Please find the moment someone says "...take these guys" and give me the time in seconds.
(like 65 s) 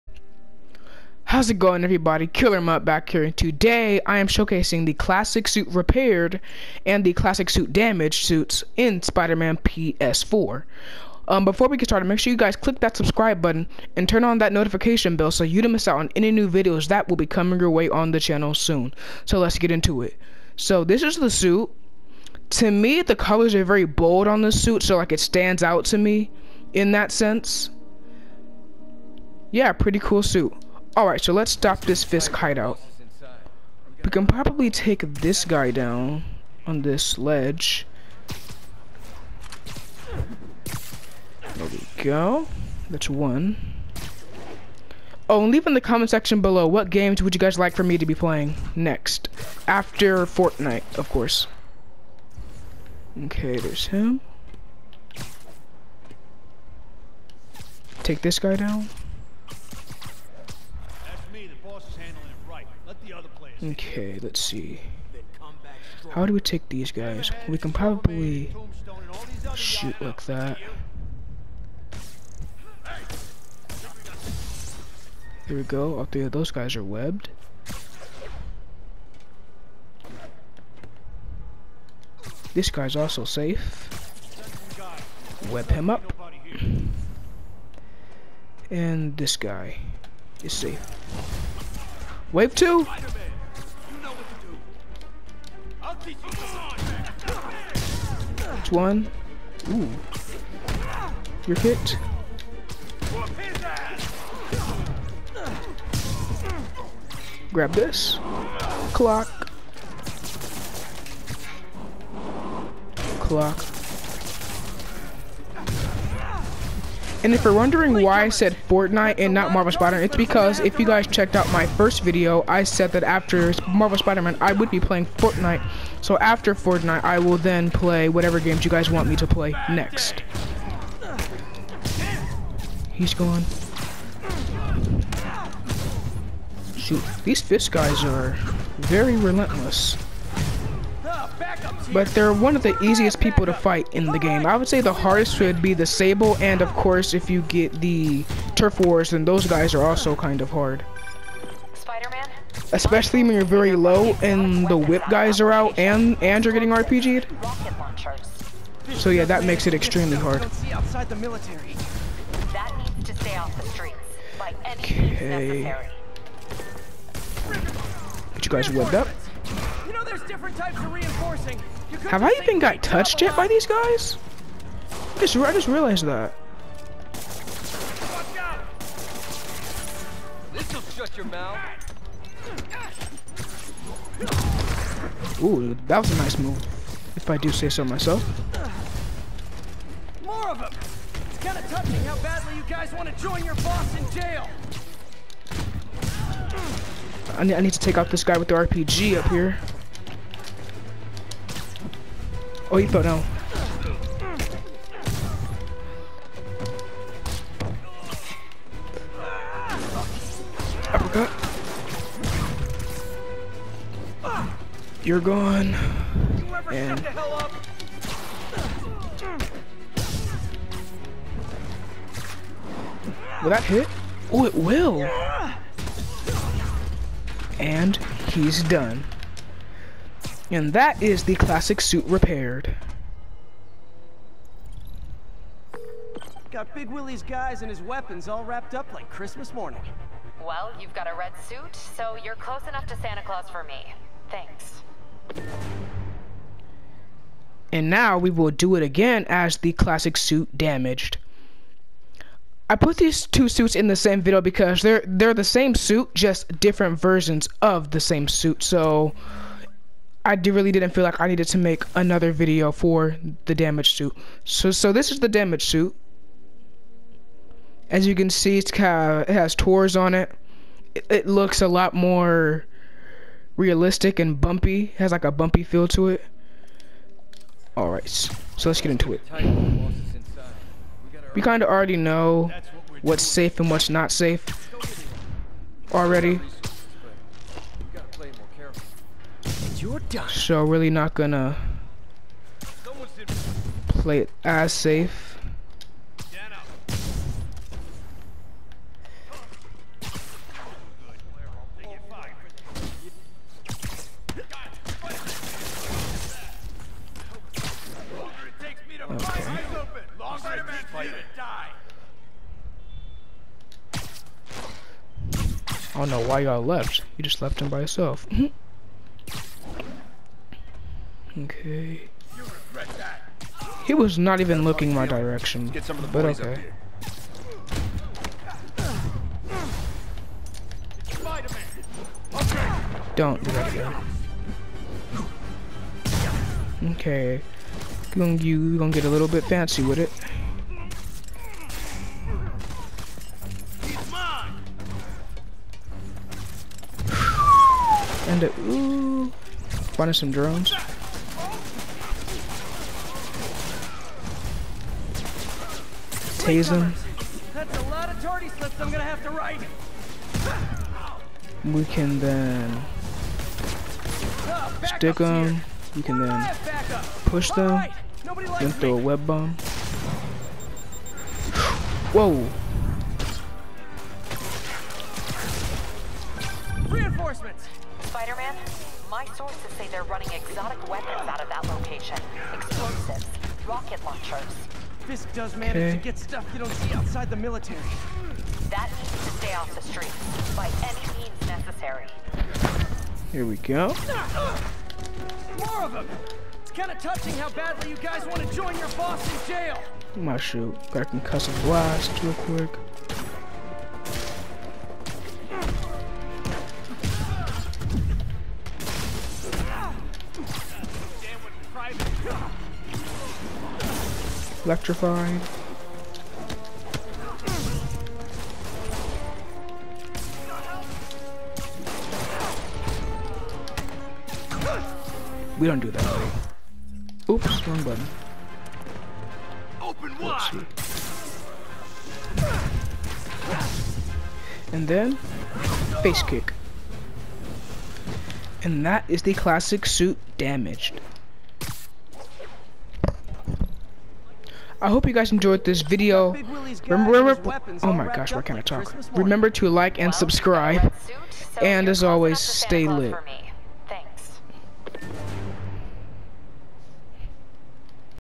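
66 s.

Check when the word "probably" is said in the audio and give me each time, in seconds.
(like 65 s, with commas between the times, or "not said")
34 s, 67 s.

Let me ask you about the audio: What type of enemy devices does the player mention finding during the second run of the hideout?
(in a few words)
Drones.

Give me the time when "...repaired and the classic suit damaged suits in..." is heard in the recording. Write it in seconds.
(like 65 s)
5 s.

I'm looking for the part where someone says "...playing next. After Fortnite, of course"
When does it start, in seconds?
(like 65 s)
48 s.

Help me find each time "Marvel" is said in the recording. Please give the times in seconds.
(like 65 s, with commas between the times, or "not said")
119 s, 123 s.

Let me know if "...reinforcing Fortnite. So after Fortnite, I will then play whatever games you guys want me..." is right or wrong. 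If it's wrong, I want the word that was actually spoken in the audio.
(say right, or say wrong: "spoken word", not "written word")
wrong: "playing", not "reinforcing".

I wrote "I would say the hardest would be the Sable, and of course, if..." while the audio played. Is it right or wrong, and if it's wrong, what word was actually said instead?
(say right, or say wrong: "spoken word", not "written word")
right.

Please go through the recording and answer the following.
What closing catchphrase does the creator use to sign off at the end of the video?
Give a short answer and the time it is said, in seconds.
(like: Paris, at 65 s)
Stay lit, at 452 s.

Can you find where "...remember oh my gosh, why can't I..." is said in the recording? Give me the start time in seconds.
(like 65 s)
447 s.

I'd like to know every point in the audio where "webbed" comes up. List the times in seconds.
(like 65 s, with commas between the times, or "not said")
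76 s, 168 s.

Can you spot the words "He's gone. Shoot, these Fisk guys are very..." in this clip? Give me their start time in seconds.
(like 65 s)
132 s.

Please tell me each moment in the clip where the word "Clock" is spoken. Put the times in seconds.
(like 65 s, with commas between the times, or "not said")
108 s, 113 s.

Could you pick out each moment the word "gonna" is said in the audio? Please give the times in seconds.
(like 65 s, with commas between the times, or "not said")
291 s, 338 s.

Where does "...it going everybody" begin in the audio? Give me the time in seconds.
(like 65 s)
1 s.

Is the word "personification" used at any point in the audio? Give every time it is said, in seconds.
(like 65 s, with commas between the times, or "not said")
not said.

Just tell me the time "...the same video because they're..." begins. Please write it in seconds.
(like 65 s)
253 s.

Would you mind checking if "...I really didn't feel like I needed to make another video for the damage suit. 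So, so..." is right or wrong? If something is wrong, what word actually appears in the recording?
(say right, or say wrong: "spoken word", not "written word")
right.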